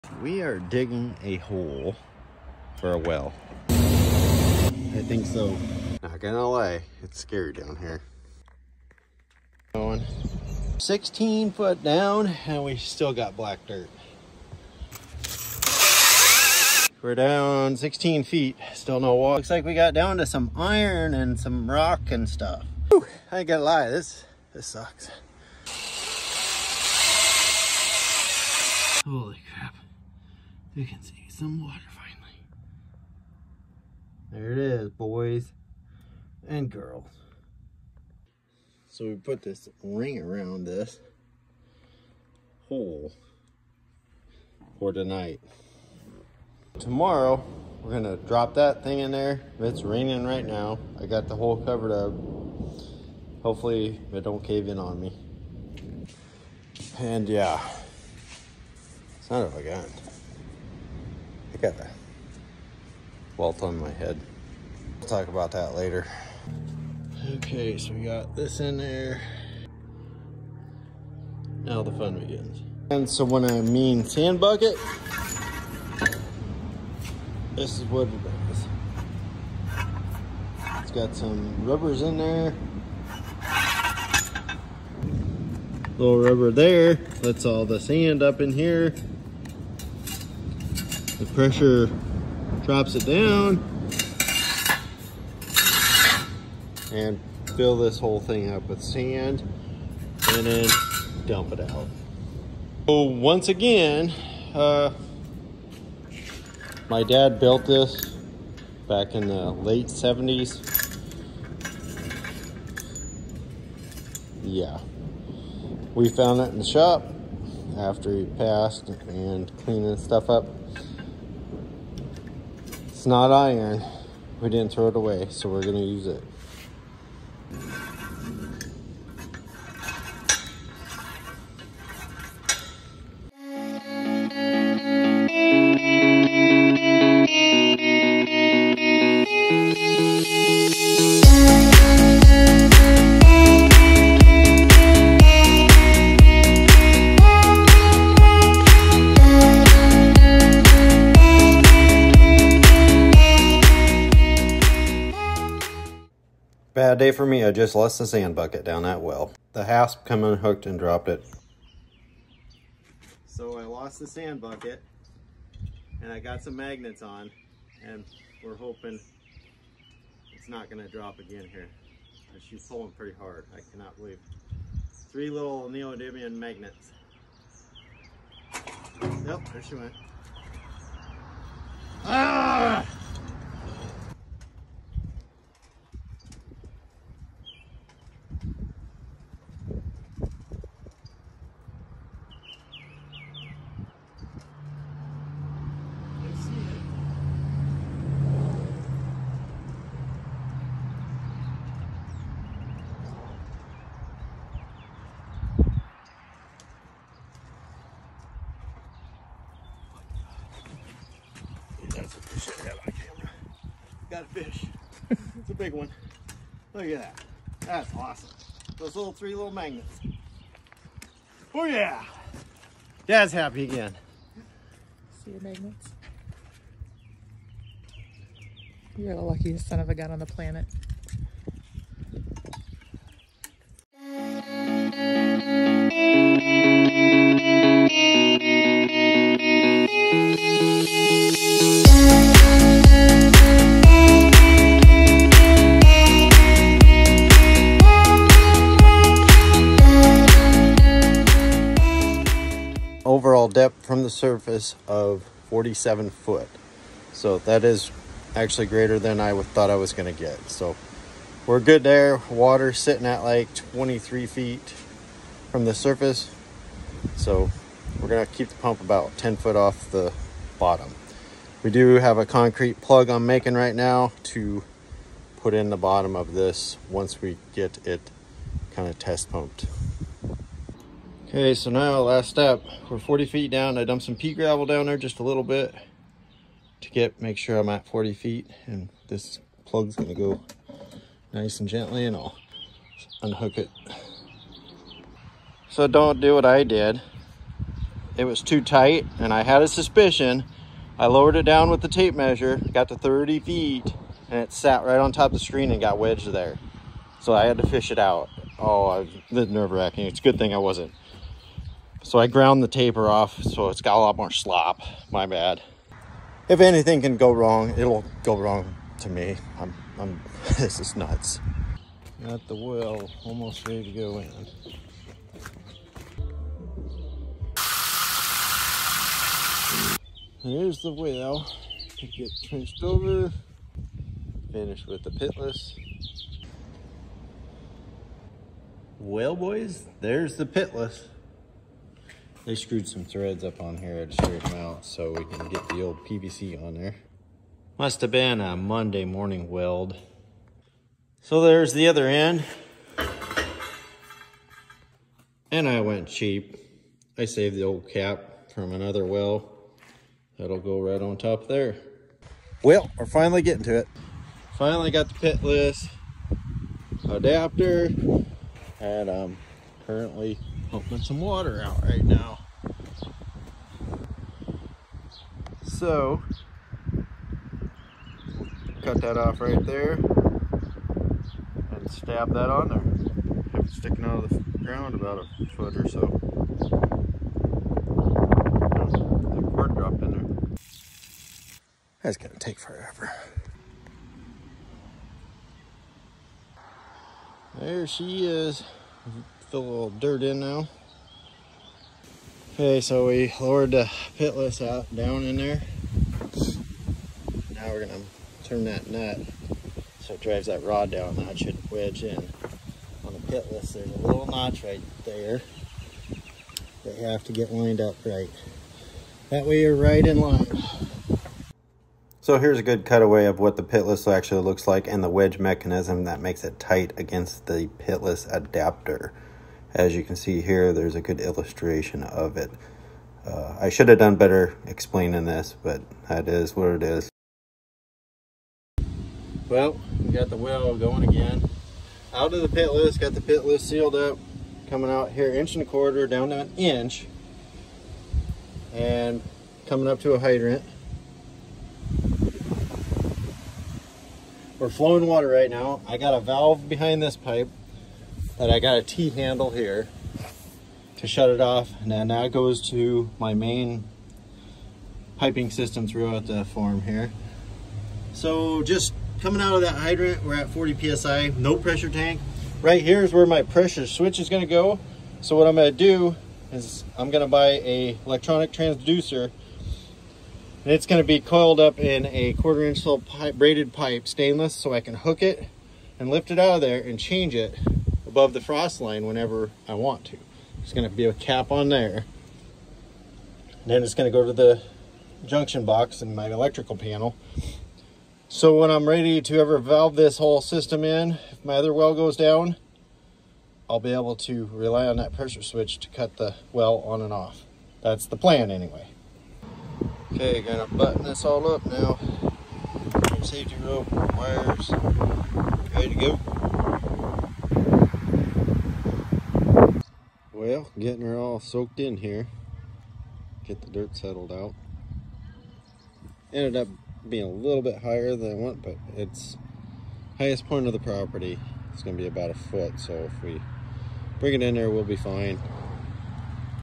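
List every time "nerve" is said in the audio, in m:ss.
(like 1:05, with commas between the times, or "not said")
5:09.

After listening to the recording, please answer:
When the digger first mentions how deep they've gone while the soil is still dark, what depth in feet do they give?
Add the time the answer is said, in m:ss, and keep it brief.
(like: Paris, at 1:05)
16 feet, at 0:10.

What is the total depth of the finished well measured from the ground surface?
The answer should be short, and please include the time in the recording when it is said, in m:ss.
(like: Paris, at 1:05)
47 feet, at 4:15.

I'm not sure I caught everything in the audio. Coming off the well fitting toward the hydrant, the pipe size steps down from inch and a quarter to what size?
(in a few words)
1 inch.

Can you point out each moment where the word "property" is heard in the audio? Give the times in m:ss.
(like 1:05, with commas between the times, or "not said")
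8:50.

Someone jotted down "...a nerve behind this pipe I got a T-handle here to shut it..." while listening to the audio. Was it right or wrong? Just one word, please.
wrong.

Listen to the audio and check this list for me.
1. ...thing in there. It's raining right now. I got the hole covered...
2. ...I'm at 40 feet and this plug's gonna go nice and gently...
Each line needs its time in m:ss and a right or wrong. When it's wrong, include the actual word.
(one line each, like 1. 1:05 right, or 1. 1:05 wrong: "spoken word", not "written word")
1. 0:48 right
2. 4:47 right.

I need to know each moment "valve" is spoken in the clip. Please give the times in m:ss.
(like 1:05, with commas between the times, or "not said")
7:36, 8:19.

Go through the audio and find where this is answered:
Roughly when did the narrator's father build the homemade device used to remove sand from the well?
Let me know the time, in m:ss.
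1:49.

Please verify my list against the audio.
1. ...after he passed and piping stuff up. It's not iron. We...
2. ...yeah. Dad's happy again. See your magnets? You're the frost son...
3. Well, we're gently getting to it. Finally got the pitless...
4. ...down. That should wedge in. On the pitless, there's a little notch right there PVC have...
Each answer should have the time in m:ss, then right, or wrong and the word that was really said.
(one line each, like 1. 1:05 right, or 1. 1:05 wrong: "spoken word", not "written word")
1. 1:57 wrong: "cleaning", not "piping"
2. 3:41 wrong: "luckiest", not "frost"
3. 6:02 wrong: "finally", not "gently"
4. 6:50 wrong: "They", not "PVC".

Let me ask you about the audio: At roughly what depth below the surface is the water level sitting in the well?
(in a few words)
23 feet.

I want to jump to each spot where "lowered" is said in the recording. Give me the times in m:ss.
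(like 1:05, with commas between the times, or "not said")
5:01, 6:43.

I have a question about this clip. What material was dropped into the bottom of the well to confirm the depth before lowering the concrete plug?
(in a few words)
pea gravel.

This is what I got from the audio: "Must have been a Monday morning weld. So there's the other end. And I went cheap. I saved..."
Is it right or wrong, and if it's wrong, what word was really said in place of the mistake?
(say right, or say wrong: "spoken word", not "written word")
right.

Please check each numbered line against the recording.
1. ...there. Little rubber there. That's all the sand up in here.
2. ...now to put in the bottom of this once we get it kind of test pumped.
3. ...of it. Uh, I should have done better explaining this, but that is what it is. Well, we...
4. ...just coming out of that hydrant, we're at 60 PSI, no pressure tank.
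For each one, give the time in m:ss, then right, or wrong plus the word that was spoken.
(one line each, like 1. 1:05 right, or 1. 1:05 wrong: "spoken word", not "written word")
1. 1:22 right
2. 4:33 right
3. 7:12 right
4. 7:48 wrong: "40", not "60".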